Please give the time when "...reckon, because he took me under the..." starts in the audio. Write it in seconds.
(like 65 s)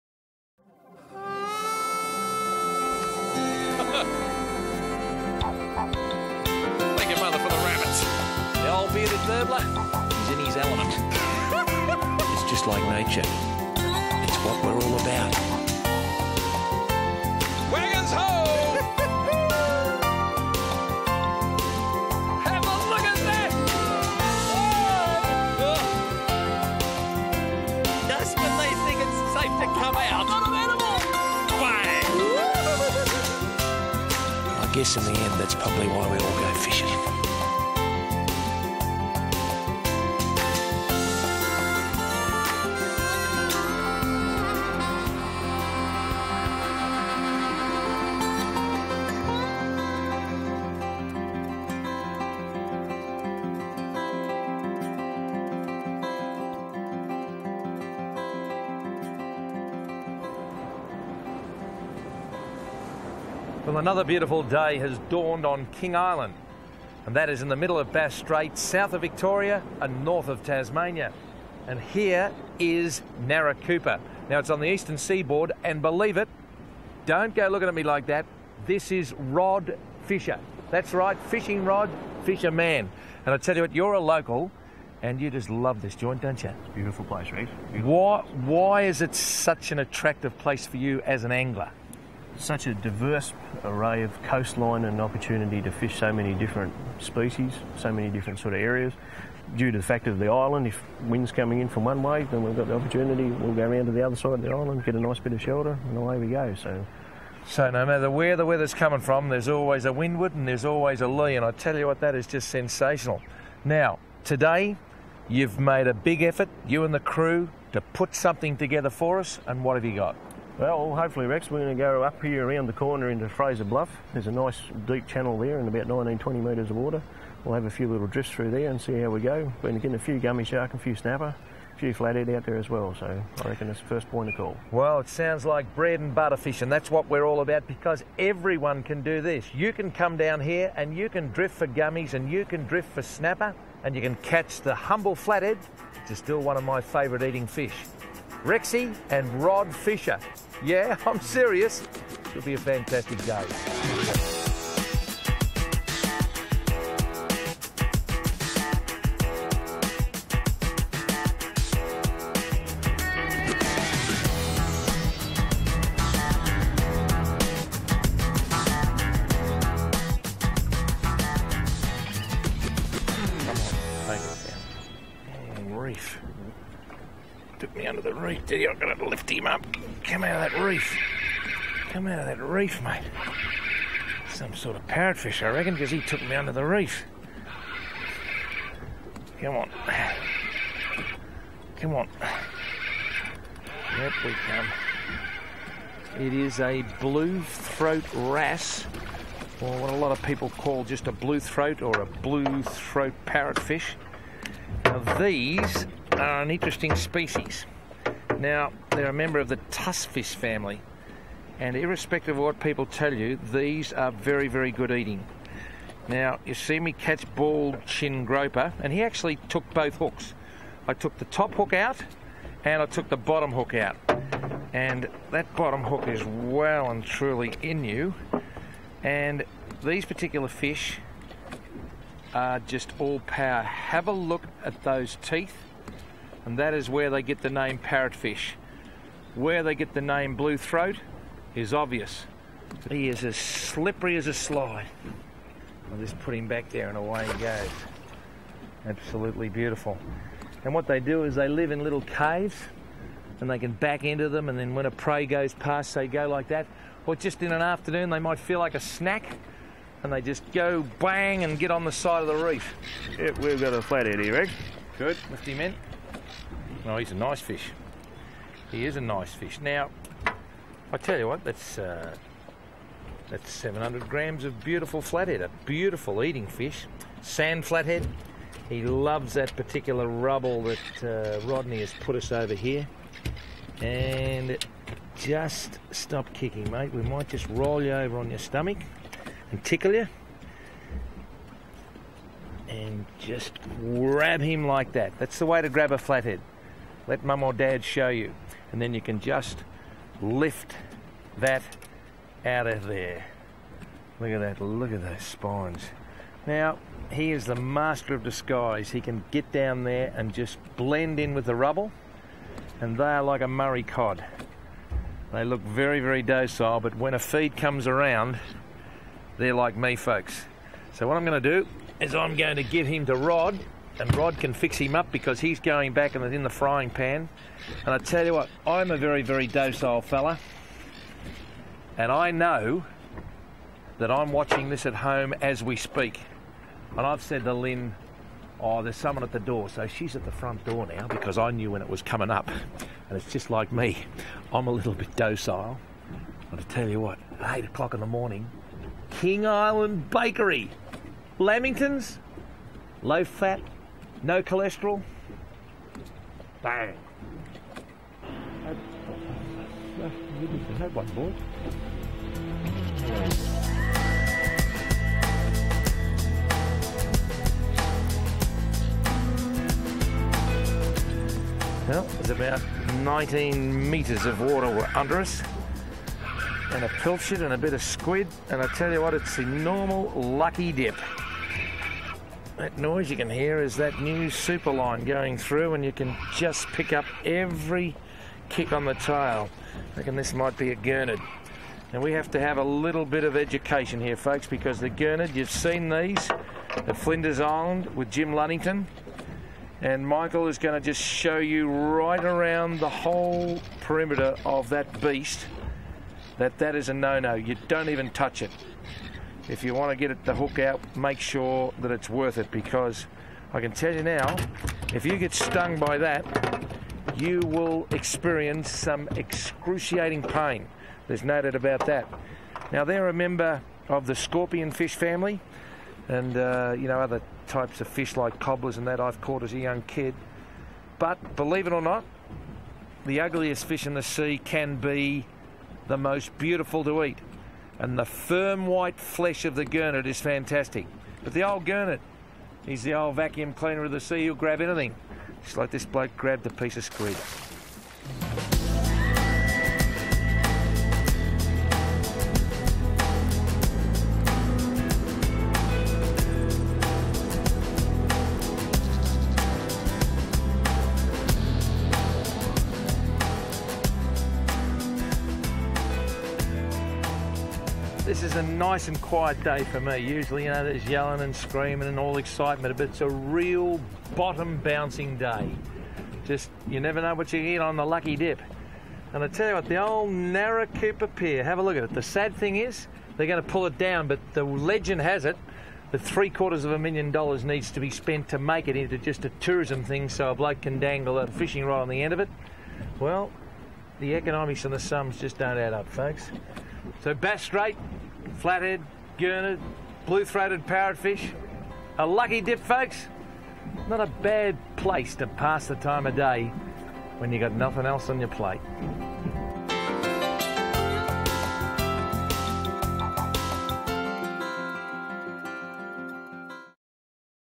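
185 s.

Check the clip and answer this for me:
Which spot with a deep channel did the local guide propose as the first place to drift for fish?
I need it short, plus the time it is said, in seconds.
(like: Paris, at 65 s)
Fraser Bluff, at 123 s.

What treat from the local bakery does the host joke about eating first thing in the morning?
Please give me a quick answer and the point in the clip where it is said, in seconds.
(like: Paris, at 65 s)
Lamingtons, at 351 s.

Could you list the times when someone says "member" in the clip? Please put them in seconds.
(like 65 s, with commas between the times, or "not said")
209 s, 423 s.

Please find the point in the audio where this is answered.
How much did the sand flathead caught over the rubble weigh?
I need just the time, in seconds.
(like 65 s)
273 s.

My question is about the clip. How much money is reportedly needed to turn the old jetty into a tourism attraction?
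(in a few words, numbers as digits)
three quarters of a million dollars.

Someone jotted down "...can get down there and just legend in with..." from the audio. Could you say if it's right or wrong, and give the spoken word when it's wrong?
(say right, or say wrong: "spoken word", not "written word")
wrong: "blend", not "legend".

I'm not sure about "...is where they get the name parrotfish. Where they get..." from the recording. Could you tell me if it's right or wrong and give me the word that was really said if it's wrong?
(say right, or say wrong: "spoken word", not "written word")
right.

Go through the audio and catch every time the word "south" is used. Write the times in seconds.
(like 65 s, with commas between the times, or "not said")
68 s.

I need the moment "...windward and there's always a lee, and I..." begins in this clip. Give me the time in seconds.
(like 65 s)
109 s.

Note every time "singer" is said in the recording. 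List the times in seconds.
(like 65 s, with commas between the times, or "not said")
not said.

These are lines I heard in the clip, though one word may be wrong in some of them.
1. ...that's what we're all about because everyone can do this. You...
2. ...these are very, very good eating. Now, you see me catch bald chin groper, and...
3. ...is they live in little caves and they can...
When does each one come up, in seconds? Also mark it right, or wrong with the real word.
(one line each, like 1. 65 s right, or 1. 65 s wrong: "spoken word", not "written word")
1. 136 s right
2. 213 s right
3. 251 s right.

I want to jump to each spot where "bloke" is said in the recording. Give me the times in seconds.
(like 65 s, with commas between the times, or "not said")
445 s, 490 s.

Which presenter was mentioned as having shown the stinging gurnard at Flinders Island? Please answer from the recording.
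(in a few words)
Jim Lunnington.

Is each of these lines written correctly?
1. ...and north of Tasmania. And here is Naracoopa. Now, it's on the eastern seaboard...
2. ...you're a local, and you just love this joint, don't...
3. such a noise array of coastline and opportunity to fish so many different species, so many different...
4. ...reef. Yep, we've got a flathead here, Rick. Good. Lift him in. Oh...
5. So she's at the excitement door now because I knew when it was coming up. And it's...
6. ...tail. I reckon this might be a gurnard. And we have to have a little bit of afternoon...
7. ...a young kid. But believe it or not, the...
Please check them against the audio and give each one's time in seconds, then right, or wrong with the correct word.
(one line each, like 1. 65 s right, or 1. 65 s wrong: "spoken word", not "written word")
1. 69 s right
2. 83 s right
3. 92 s wrong: "diverse", not "noise"
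4. 262 s right
5. 339 s wrong: "front", not "excitement"
6. 388 s wrong: "education", not "afternoon"
7. 429 s right.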